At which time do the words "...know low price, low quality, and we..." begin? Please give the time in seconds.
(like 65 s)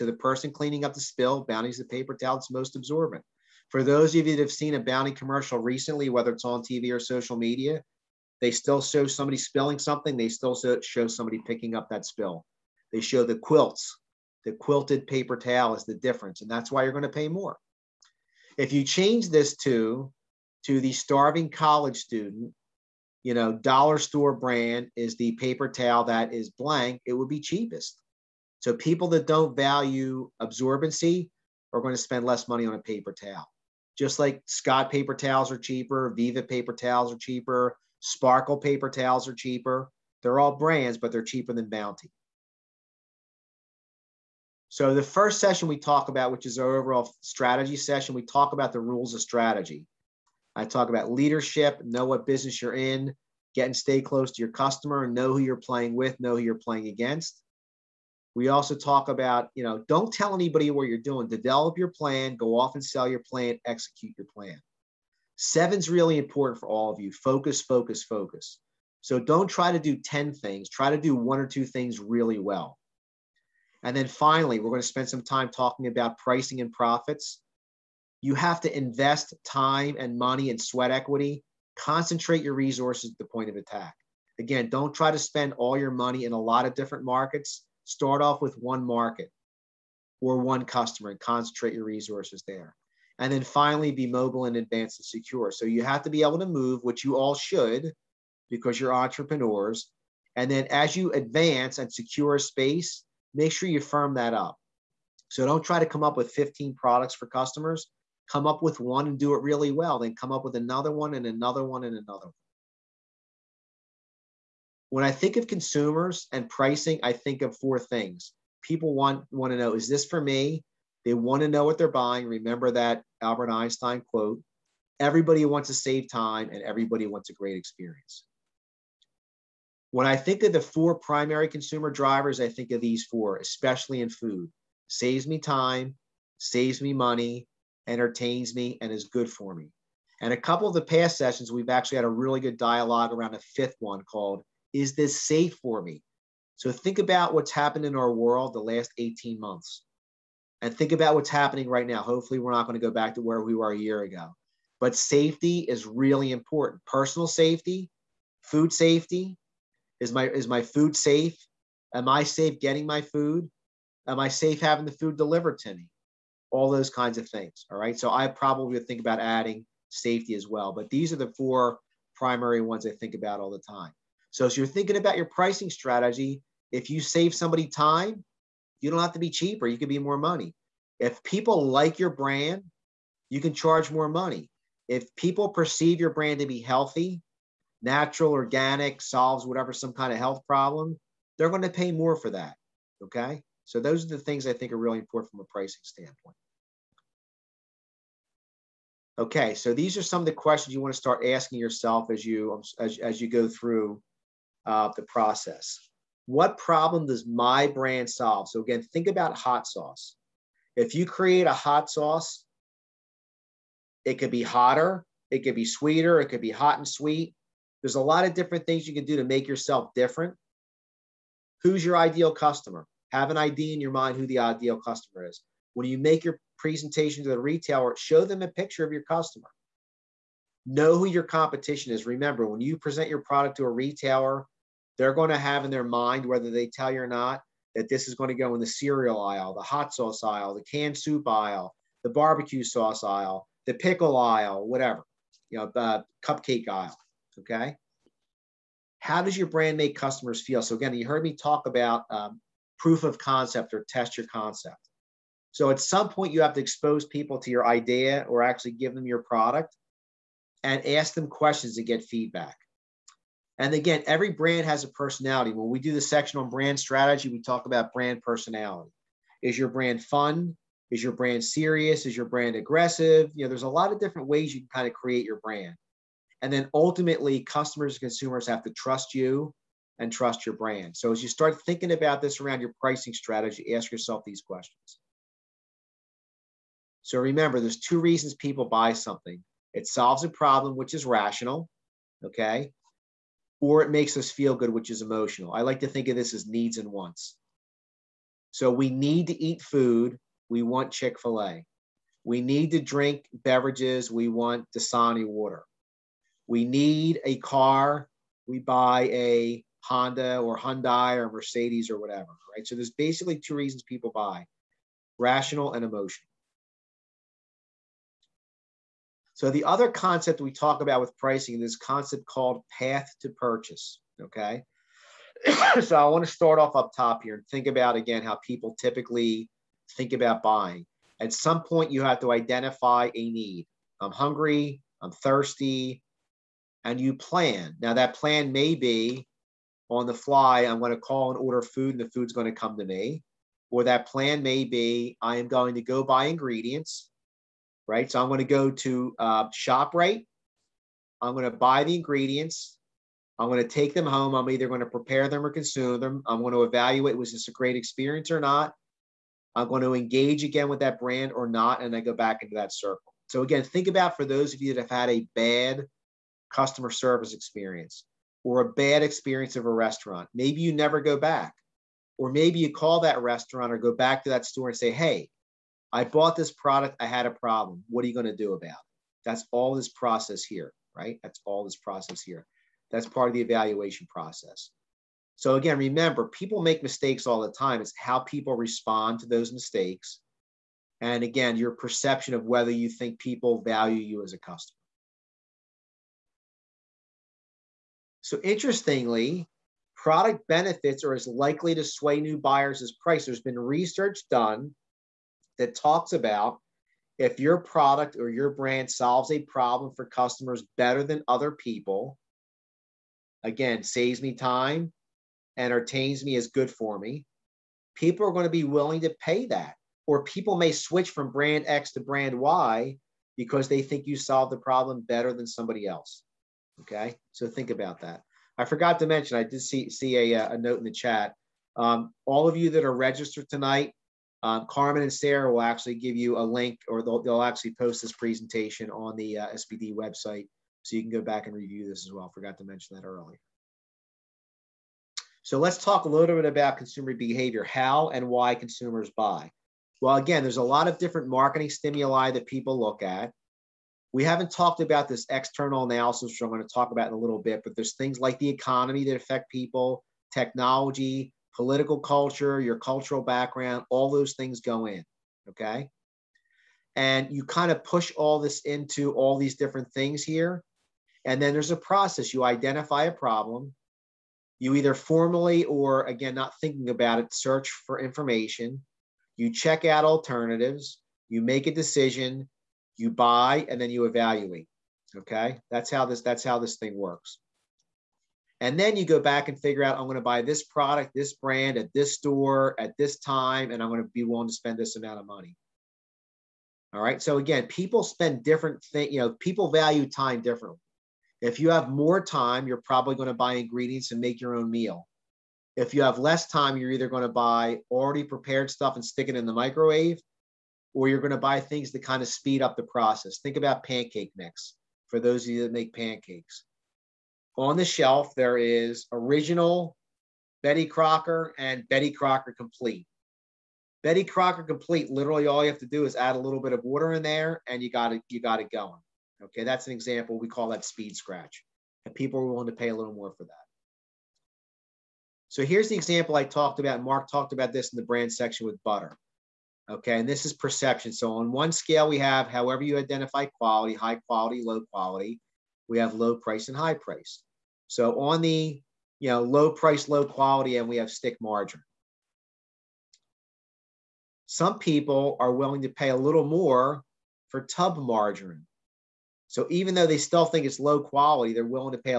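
549 s.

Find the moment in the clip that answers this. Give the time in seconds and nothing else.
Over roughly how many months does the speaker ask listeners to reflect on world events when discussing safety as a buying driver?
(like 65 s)
148 s.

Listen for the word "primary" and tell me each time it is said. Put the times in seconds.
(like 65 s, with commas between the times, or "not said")
130 s, 172 s.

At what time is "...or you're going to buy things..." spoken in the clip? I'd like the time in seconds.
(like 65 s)
510 s.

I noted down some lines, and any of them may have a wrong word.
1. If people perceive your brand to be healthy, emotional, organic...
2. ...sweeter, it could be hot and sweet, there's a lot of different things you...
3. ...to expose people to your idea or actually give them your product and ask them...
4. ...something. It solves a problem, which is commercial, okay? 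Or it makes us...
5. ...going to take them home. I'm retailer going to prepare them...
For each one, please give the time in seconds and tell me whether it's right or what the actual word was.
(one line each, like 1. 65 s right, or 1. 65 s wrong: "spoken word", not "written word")
1. 184 s wrong: "natural", not "emotional"
2. 215 s right
3. 256 s right
4. 288 s wrong: "rational", not "commercial"
5. 353 s wrong: "either", not "retailer".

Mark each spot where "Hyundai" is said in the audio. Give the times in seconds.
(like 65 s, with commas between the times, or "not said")
310 s.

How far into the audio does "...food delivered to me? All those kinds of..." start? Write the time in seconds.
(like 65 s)
164 s.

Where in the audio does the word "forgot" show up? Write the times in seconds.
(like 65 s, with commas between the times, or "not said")
428 s, 442 s.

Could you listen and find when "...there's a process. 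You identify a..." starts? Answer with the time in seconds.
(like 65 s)
471 s.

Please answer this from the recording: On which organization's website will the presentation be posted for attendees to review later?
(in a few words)
SBDC.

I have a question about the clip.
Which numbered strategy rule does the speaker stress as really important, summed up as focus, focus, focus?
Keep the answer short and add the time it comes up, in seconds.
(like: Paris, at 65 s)
Seven, at 65 s.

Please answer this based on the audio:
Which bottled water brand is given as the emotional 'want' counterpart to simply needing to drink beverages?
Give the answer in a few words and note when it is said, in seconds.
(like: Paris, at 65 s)
Dasani, at 304 s.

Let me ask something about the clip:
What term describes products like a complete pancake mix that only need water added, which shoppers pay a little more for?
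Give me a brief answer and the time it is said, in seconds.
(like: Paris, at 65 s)
speed scratch, at 530 s.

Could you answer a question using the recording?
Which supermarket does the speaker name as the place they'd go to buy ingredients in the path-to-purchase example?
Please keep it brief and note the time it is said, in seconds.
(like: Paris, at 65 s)
ShopRite, at 349 s.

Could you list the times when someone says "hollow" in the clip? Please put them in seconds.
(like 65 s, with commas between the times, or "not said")
not said.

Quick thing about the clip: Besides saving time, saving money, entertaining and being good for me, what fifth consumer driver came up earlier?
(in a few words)
Is This Safe for Me.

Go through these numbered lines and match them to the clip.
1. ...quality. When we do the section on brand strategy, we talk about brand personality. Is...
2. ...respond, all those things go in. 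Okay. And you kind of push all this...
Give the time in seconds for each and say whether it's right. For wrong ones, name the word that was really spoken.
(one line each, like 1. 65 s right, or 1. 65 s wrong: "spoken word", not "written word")
1. 264 s wrong: "personality", not "quality"
2. 463 s wrong: "background", not "respond".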